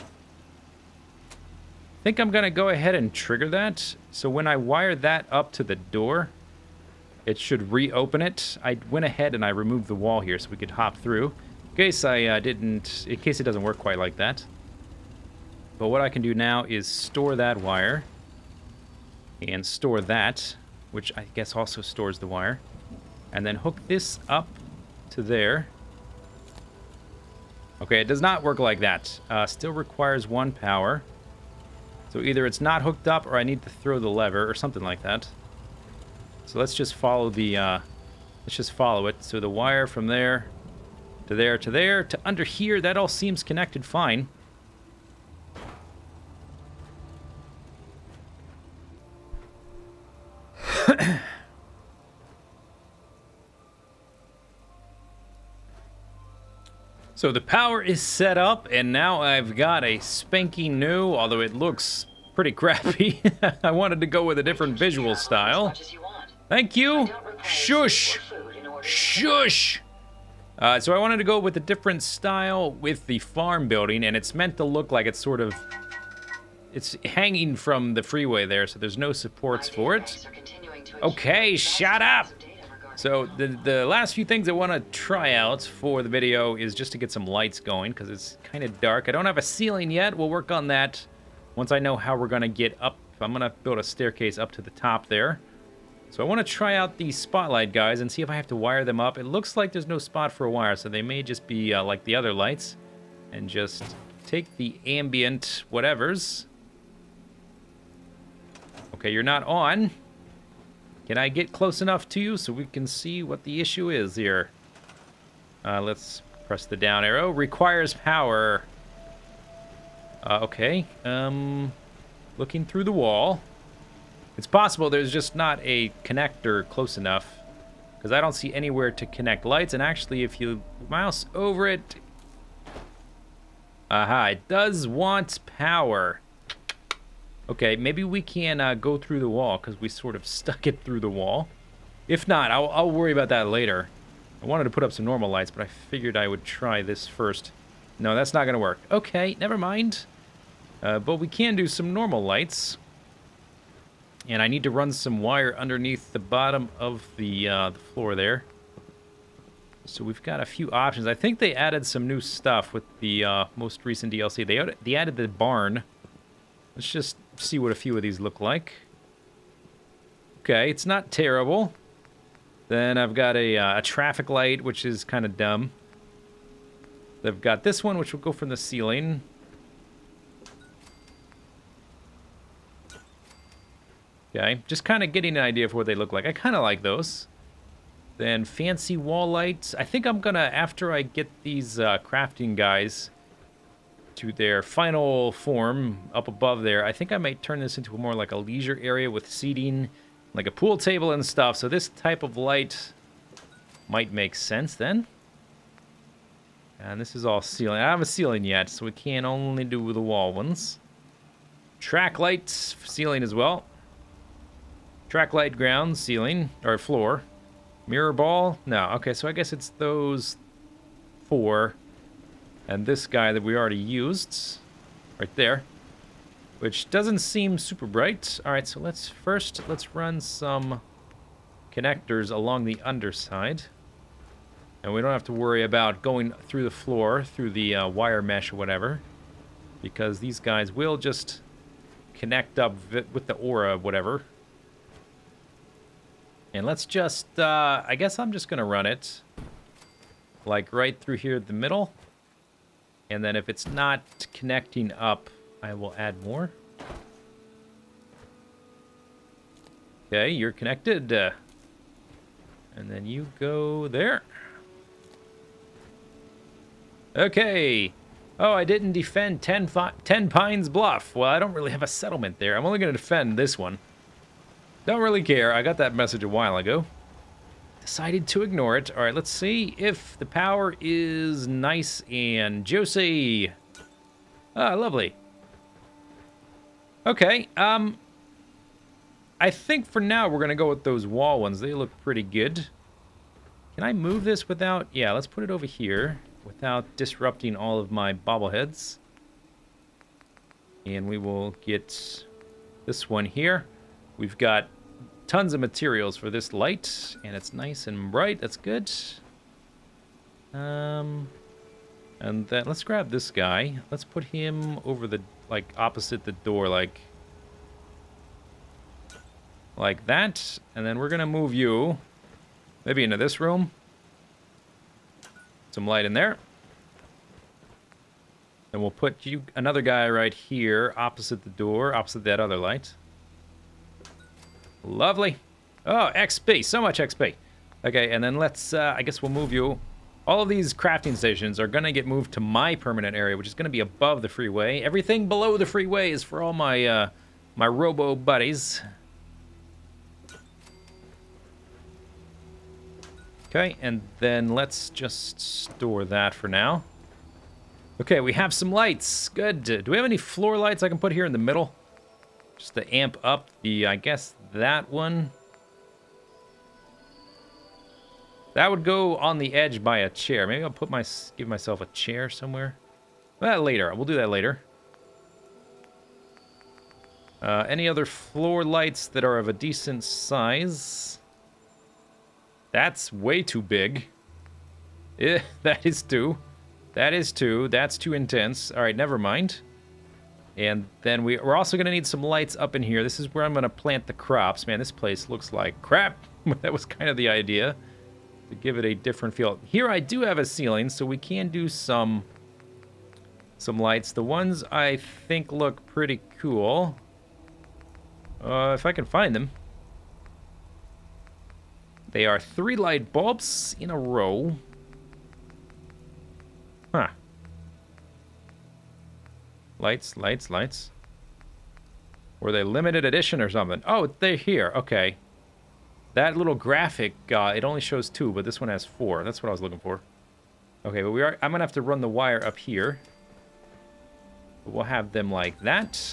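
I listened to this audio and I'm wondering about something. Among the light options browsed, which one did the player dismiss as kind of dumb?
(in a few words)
Traffic light.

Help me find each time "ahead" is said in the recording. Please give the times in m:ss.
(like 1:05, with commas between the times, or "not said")
0:02, 0:09.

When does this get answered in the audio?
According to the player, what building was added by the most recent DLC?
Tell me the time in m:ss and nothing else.
2:45.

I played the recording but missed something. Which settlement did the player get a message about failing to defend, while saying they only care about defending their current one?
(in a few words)
Tenpines Bluff.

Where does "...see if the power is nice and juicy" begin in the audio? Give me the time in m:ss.
4:39.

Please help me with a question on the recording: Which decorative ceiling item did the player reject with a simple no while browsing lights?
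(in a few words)
Mirror ball.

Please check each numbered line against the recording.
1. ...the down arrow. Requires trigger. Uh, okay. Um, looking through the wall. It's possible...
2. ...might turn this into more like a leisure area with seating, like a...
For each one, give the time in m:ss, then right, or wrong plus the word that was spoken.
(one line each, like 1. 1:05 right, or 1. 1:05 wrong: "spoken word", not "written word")
1. 1:56 wrong: "power", not "trigger"
2. 3:17 right.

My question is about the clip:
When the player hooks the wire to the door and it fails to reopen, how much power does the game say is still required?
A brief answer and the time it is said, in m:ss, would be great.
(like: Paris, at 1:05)
1, at 0:30.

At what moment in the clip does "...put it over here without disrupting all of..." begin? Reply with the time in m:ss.
4:55.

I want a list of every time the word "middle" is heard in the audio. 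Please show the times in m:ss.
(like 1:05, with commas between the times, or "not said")
4:11, 6:01.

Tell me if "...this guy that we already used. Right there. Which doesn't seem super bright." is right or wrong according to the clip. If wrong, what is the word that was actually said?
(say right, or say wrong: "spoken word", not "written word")
right.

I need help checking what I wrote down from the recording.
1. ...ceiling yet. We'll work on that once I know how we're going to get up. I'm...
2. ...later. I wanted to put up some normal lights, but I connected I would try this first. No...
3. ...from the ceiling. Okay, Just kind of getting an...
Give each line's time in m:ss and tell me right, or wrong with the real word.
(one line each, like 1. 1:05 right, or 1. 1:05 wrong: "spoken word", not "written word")
1. 1:29 right
2. 2:23 wrong: "figured", not "connected"
3. 2:58 right.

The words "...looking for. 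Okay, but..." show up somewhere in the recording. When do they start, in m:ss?
7:09.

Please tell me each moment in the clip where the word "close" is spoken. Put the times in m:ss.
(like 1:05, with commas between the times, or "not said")
1:51, 2:06.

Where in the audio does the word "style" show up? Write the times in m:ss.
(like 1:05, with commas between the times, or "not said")
1:05, 1:12.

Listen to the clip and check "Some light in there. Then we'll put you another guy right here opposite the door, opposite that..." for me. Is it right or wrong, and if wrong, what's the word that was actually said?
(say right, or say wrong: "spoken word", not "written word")
right.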